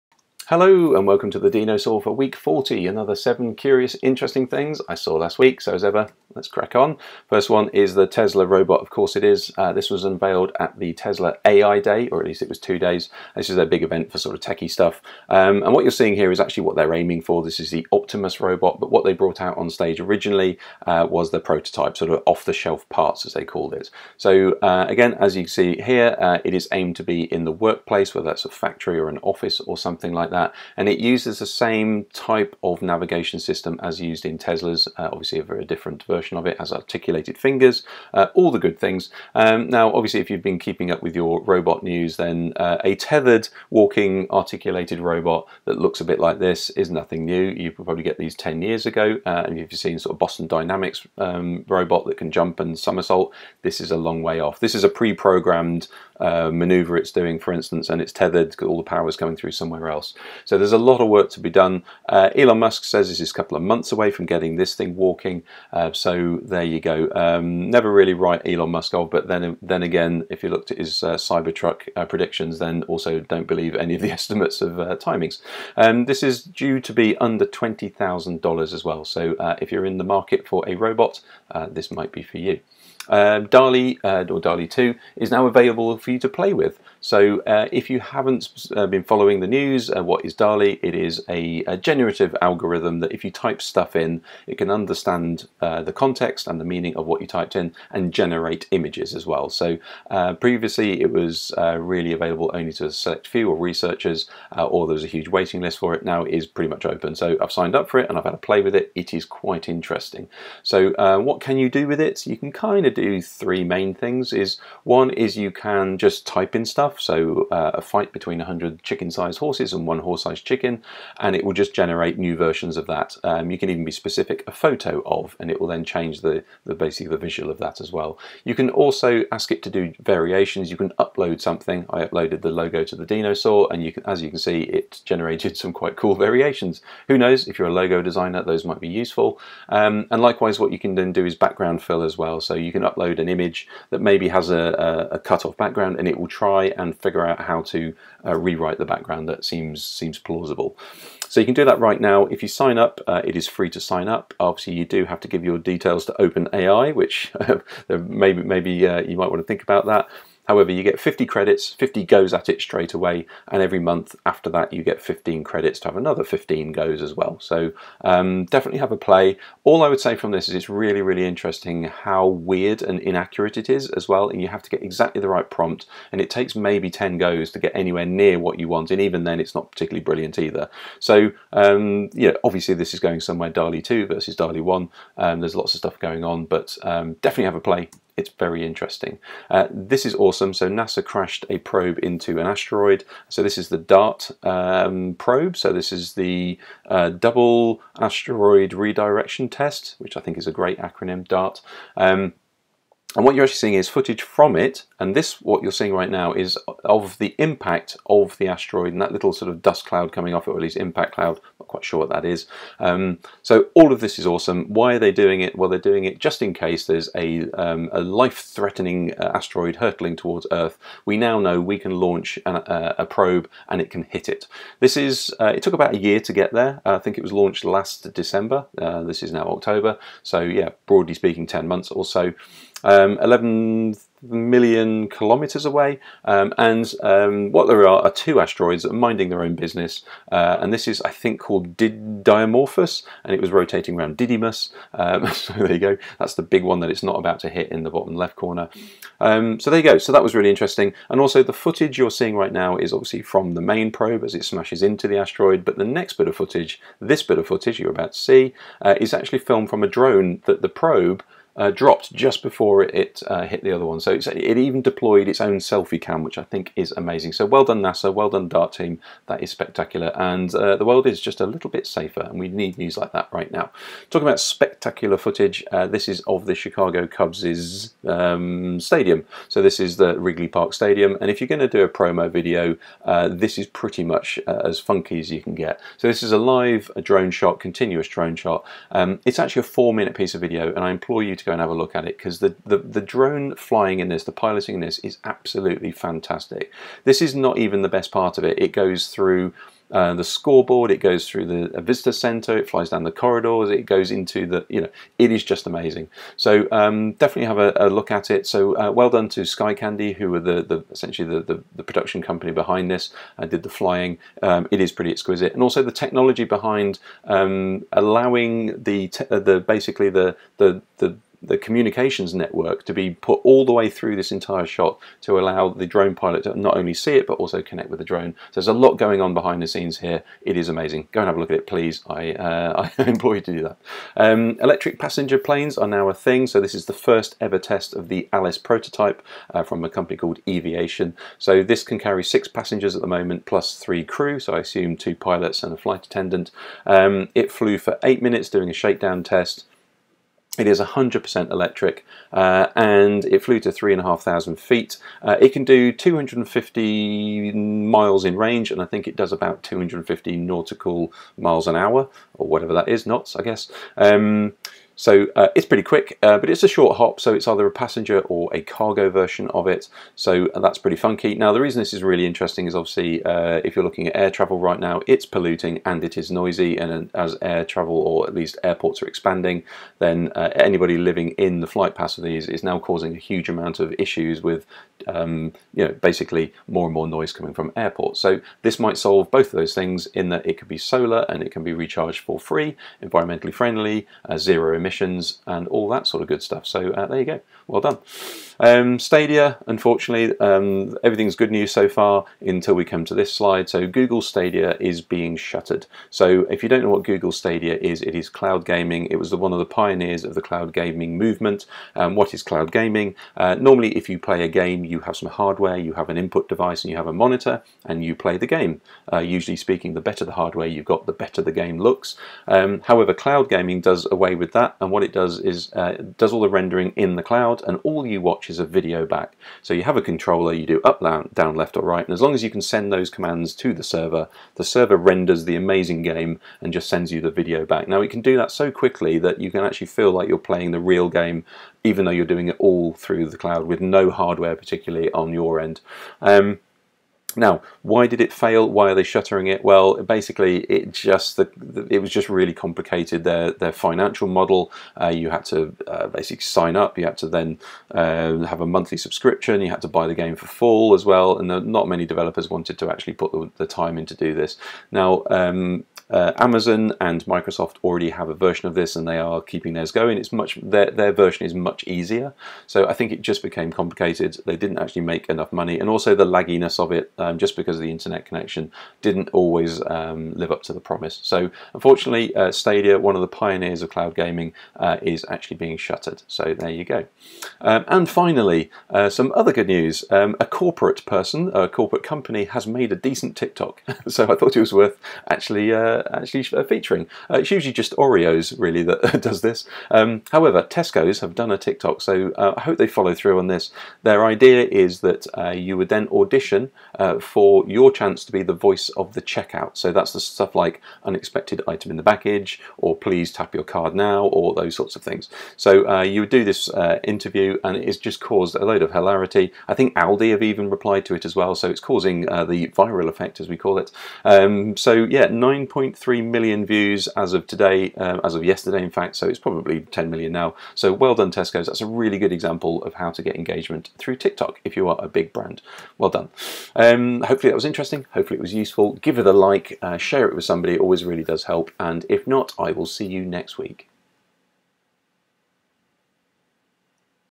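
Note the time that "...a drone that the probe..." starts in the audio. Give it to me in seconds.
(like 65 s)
259 s.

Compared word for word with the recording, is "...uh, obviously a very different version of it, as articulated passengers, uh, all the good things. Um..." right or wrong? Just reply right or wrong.
wrong.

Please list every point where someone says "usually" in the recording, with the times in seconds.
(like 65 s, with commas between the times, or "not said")
419 s, 497 s.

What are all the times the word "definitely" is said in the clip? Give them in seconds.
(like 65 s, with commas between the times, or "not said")
168 s, 187 s, 307 s.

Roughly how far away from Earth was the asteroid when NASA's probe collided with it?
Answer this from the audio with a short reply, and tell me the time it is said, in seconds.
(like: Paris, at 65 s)
11 million kilometers, at 233 s.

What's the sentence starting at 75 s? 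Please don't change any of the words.
Um, this is due to be under $20,000 as well.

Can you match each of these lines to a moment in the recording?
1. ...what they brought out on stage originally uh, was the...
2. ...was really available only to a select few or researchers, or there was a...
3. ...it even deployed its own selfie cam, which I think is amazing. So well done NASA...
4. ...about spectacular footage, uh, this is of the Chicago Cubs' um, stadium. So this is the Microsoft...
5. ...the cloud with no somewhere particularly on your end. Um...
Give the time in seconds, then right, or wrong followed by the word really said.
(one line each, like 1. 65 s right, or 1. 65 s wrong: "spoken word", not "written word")
1. 18 s right
2. 101 s right
3. 264 s right
4. 274 s wrong: "Wrigley", not "Microsoft"
5. 443 s wrong: "hardware", not "somewhere".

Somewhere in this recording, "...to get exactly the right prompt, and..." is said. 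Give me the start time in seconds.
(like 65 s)
174 s.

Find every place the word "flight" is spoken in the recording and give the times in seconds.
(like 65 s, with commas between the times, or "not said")
345 s, 381 s.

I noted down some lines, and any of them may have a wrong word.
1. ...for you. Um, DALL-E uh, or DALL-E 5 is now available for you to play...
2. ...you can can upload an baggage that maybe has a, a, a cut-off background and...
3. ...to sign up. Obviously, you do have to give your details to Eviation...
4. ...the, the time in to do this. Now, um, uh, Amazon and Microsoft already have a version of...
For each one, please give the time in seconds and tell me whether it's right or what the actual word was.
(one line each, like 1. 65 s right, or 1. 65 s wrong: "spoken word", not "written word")
1. 82 s wrong: "2", not "5"
2. 142 s wrong: "image", not "baggage"
3. 153 s wrong: "OpenAI", not "Eviation"
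4. 463 s right.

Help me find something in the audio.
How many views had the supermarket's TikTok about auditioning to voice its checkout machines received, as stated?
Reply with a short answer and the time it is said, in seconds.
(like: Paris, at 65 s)
9.3 million, at 525 s.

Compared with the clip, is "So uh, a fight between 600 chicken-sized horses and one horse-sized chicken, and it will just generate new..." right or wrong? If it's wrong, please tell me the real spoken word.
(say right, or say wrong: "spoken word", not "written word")
wrong: "100", not "600".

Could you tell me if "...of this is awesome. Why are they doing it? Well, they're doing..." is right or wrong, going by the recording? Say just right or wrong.
right.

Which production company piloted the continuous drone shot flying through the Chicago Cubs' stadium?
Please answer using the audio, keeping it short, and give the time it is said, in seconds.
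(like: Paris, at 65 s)
Sky Candy, at 309 s.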